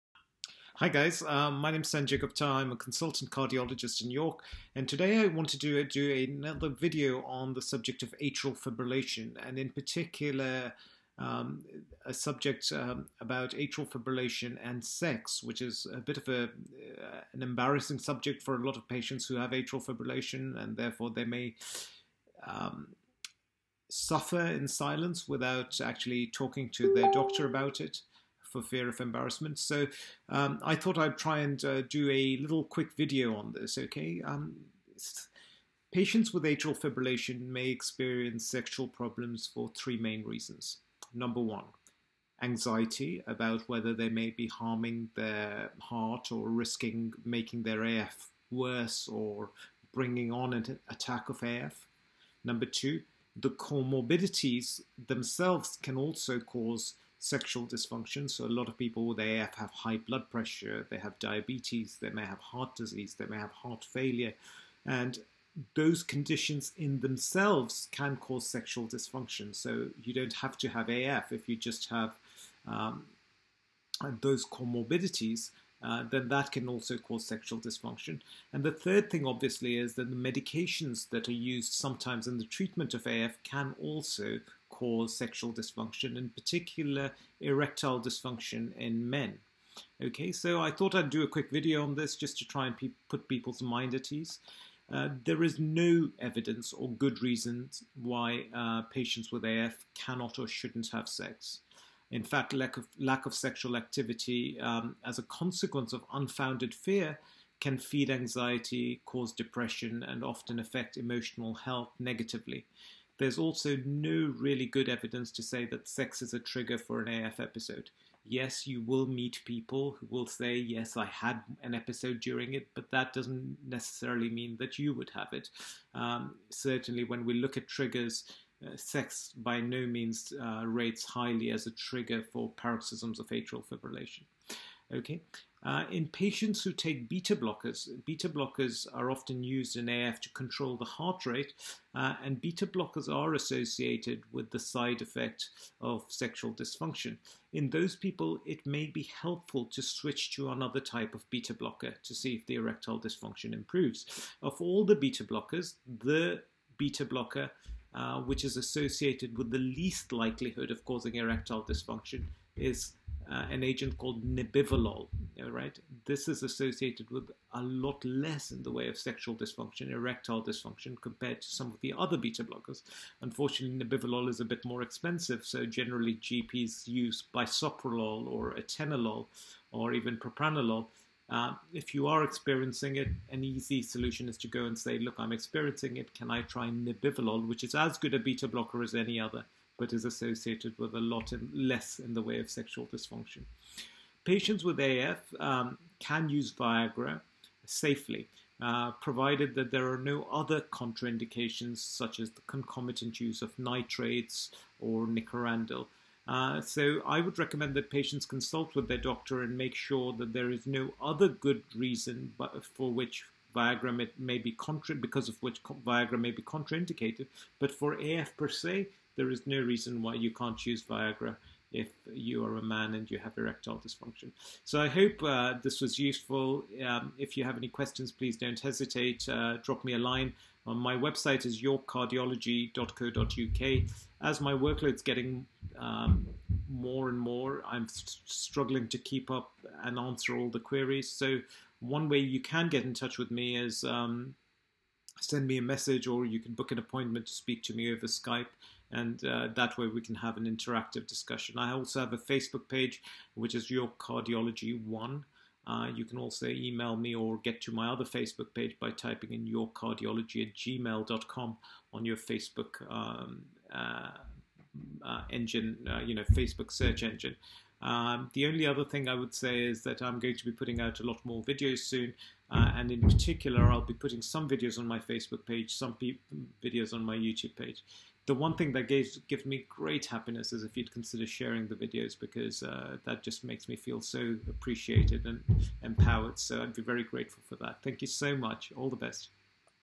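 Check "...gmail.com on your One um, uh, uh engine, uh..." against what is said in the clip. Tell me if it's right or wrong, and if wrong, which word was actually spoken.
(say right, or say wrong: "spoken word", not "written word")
wrong: "Facebook", not "One".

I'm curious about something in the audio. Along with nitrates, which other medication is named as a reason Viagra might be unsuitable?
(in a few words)
Nicorandil.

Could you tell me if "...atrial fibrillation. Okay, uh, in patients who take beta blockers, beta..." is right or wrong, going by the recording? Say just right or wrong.
right.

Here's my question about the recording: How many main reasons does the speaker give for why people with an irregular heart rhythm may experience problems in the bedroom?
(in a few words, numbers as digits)
3.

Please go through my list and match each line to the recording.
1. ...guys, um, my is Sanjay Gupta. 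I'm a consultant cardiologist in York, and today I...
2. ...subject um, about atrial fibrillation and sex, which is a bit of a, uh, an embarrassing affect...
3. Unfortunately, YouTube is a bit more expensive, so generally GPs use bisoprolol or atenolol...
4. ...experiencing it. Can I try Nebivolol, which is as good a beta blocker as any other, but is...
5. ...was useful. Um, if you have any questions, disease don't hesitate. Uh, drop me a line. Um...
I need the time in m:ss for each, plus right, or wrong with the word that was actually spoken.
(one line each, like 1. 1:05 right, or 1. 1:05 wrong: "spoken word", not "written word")
1. 0:00 right
2. 0:12 wrong: "subject", not "affect"
3. 2:53 wrong: "Nebivolol", not "YouTube"
4. 3:05 right
5. 3:45 wrong: "please", not "disease".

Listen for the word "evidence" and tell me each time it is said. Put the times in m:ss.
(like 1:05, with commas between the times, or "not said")
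1:36, 1:54.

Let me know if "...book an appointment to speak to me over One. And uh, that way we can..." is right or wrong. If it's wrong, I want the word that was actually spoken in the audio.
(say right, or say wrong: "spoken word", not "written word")
wrong: "Skype", not "One".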